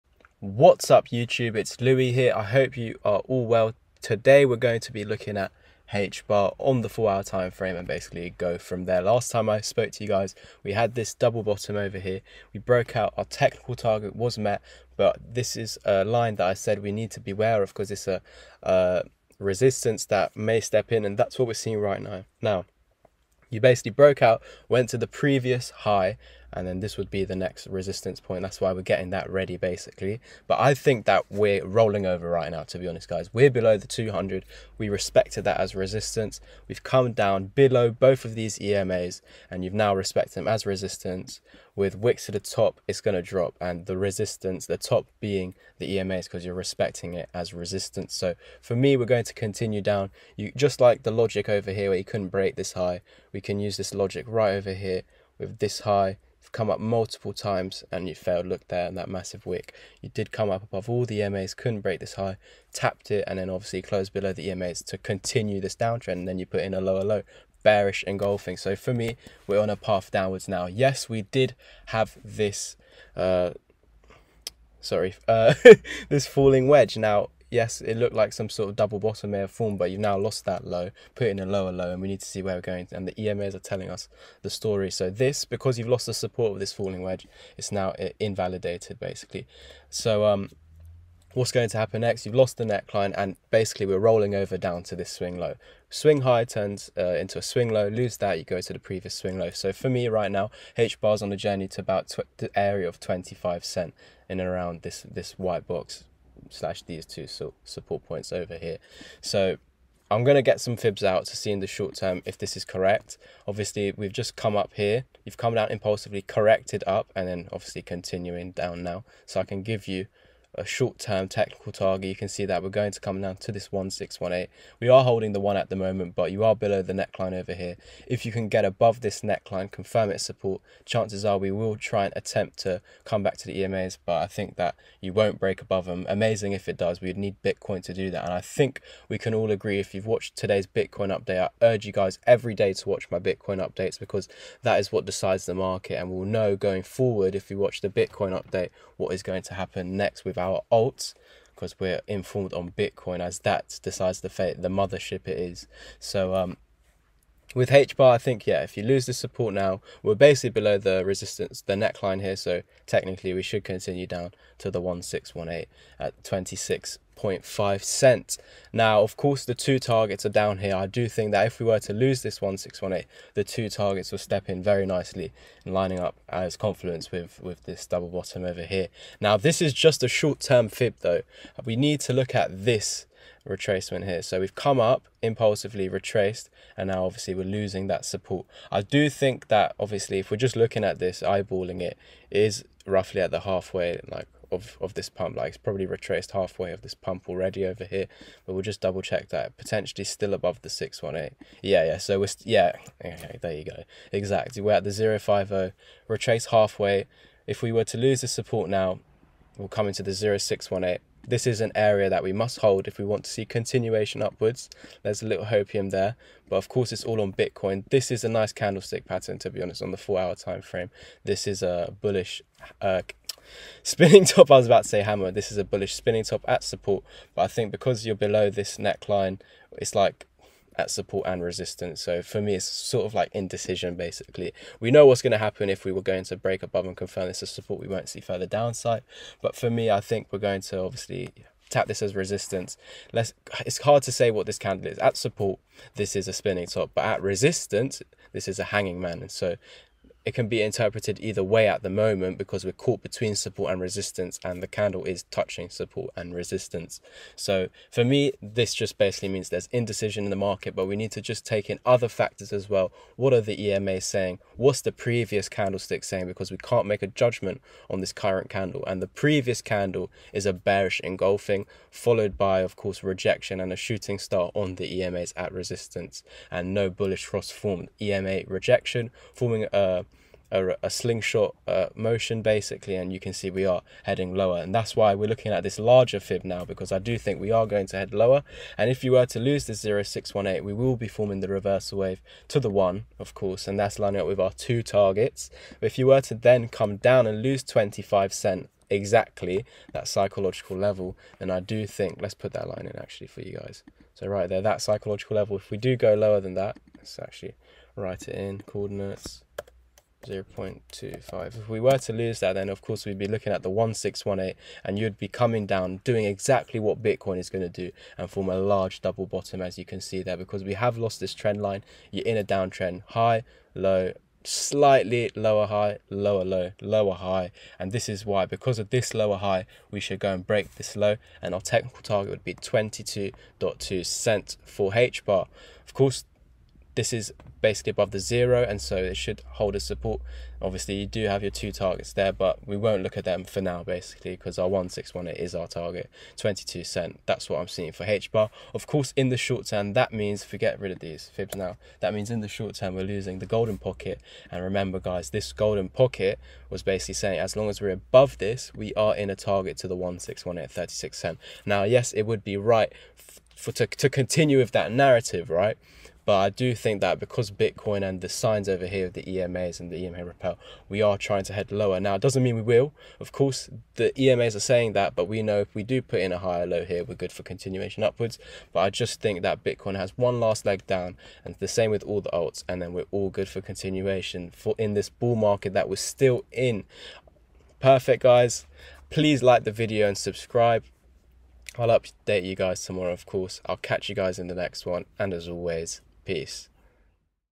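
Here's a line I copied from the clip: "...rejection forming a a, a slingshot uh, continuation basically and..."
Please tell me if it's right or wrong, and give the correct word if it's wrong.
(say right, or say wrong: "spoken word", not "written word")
wrong: "motion", not "continuation".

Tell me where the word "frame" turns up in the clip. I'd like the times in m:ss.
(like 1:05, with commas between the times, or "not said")
0:07, 3:40.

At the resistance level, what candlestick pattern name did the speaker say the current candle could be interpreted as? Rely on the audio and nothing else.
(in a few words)
Hanging man.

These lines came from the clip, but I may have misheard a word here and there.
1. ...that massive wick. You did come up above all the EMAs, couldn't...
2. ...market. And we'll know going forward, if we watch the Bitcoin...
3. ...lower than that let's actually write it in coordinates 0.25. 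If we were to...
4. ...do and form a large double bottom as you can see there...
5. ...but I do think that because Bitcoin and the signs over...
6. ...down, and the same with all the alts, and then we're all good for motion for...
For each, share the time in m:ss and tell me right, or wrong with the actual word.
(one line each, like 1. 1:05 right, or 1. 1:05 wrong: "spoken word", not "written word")
1. 0:58 right
2. 2:25 right
3. 5:06 right
4. 5:17 right
5. 6:06 right
6. 6:20 wrong: "continuation", not "motion".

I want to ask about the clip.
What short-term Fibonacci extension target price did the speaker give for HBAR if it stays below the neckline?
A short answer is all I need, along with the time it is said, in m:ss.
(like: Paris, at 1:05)
26.5 cents, at 2:46.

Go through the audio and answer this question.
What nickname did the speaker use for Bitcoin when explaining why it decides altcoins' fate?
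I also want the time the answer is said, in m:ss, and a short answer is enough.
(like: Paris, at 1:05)
The mothership, at 2:34.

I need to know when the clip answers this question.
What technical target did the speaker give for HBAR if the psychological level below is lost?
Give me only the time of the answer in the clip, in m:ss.
5:32.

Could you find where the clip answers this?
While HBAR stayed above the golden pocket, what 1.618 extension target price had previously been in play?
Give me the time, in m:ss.
6:00.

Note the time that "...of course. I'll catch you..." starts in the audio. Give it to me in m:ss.
6:33.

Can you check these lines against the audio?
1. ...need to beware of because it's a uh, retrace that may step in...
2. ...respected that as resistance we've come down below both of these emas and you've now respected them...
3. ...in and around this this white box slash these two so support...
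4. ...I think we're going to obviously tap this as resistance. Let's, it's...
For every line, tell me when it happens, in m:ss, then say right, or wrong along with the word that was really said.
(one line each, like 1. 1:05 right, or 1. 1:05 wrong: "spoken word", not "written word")
1. 0:16 wrong: "resistance", not "retrace"
2. 0:34 right
3. 1:44 right
4. 3:59 right.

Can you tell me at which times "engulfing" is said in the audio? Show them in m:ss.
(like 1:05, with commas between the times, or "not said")
1:08, 4:31.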